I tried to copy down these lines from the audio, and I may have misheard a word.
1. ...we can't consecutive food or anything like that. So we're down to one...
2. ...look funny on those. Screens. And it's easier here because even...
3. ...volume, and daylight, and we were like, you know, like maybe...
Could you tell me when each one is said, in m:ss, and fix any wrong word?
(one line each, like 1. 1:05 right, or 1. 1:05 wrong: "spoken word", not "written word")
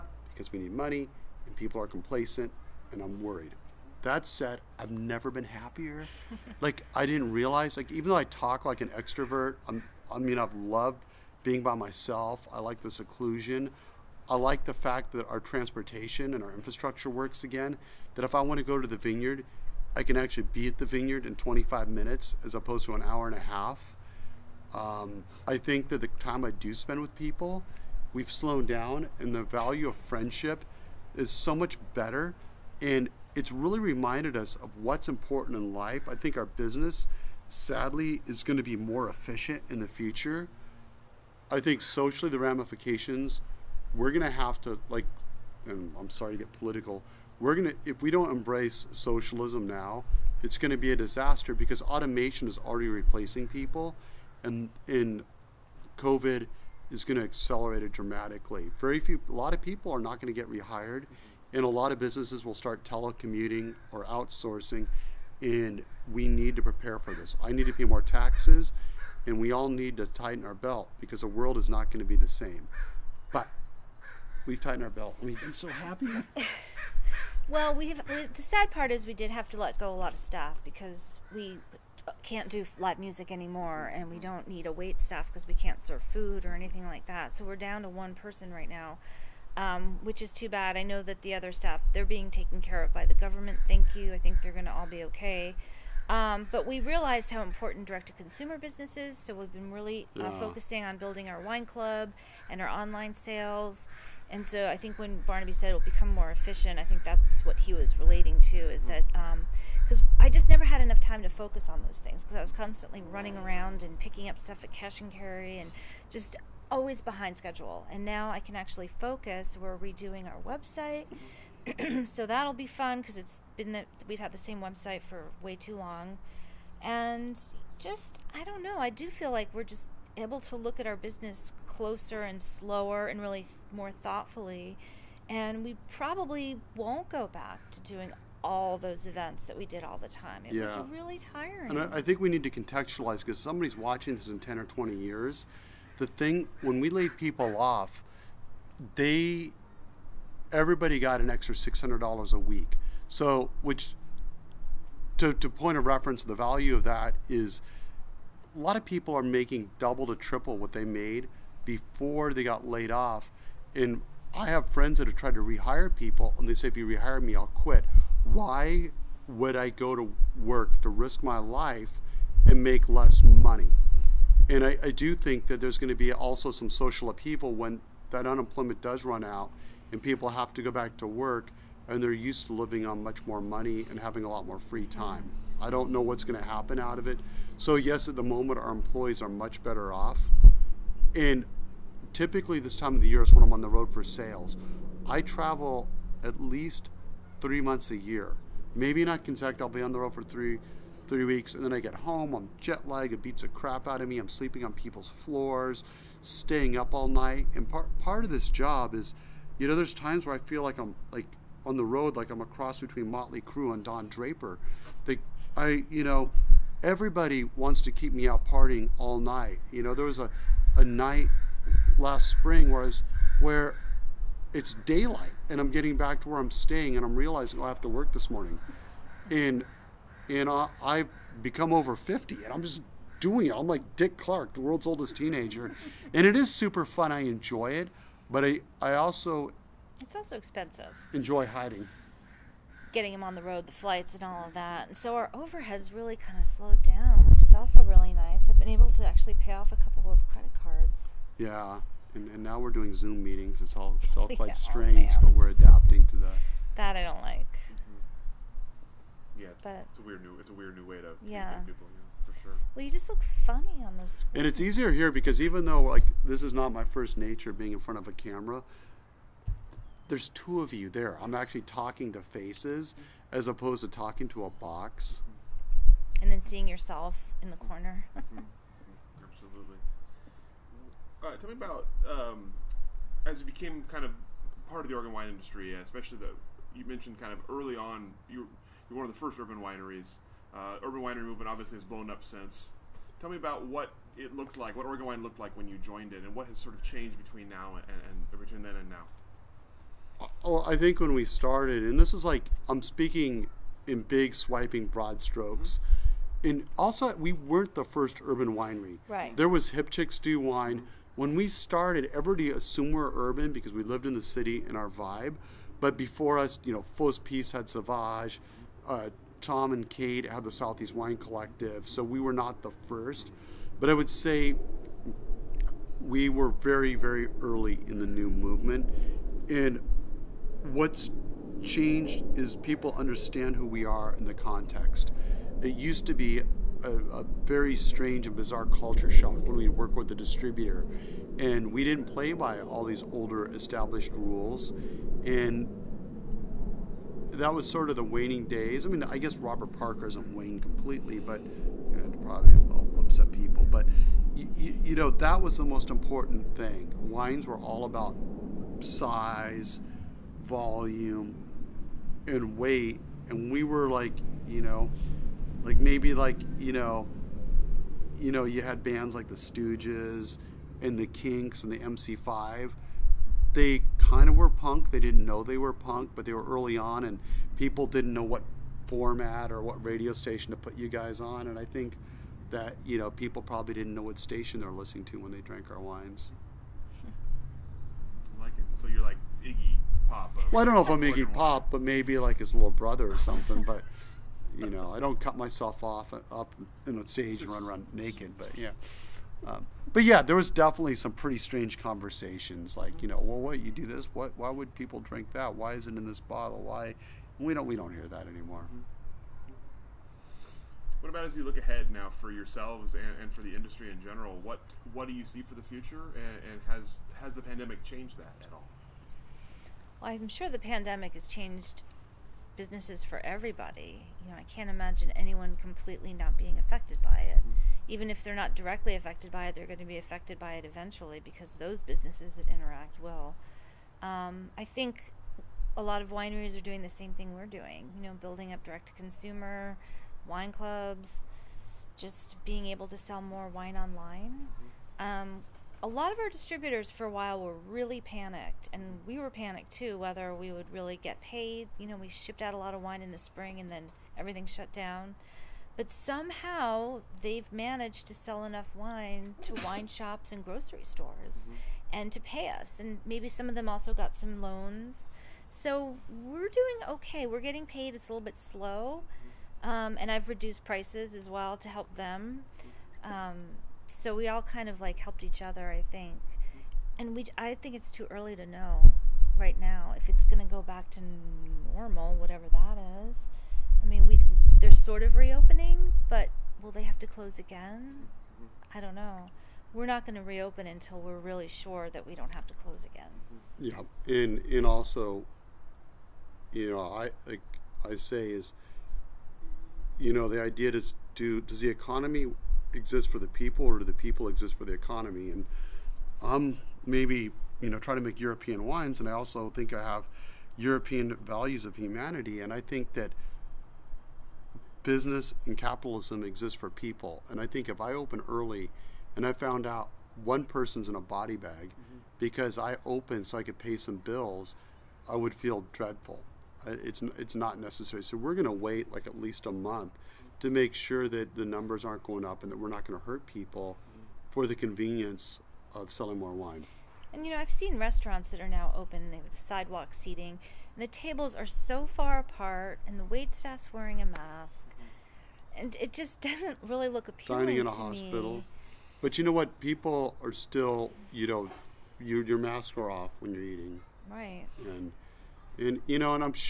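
1. 1:25 wrong: "serve", not "consecutive"
2. 4:23 right
3. 6:00 wrong: "weight", not "daylight".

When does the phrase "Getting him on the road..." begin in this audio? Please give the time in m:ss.
4:02.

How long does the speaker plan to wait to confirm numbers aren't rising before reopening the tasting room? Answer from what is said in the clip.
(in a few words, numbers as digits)
at least a month.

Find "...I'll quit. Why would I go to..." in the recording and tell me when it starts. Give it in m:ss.
2:47.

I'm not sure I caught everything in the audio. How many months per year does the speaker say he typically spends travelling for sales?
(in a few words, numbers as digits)
3.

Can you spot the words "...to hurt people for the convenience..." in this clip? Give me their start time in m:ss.
8:52.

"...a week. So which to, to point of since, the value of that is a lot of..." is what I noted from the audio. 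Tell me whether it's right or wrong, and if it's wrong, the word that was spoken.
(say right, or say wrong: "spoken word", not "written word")
wrong: "reference", not "since".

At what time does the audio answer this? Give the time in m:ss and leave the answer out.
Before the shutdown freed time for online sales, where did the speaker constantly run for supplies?
1:54.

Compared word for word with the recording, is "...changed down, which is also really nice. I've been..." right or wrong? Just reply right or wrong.
wrong.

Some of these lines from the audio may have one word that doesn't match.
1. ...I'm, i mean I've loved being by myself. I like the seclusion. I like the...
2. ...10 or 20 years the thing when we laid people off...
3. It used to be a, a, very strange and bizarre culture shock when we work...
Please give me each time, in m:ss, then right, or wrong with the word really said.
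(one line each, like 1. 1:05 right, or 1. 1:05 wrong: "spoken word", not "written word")
1. 0:09 right
2. 2:24 right
3. 5:35 right.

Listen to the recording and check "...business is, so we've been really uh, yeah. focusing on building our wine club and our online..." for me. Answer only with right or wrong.
right.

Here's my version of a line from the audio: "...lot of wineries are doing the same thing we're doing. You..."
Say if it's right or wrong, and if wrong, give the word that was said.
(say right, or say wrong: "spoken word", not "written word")
right.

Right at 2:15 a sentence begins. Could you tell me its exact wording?
And we probably won't go back to doing all those events that we did all the time.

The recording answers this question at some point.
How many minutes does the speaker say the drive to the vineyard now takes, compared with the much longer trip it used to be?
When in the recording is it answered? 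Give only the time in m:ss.
0:21.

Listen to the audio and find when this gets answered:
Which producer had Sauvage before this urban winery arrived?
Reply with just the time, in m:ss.
5:16.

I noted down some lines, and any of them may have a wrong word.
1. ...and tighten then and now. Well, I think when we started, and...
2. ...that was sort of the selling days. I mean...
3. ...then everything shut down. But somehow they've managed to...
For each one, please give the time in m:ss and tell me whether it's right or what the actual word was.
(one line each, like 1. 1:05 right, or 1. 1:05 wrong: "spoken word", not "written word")
1. 4:57 wrong: "between", not "tighten"
2. 5:47 wrong: "waning", not "selling"
3. 7:33 right.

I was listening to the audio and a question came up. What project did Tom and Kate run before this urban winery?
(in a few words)
Southeast Wine Collective.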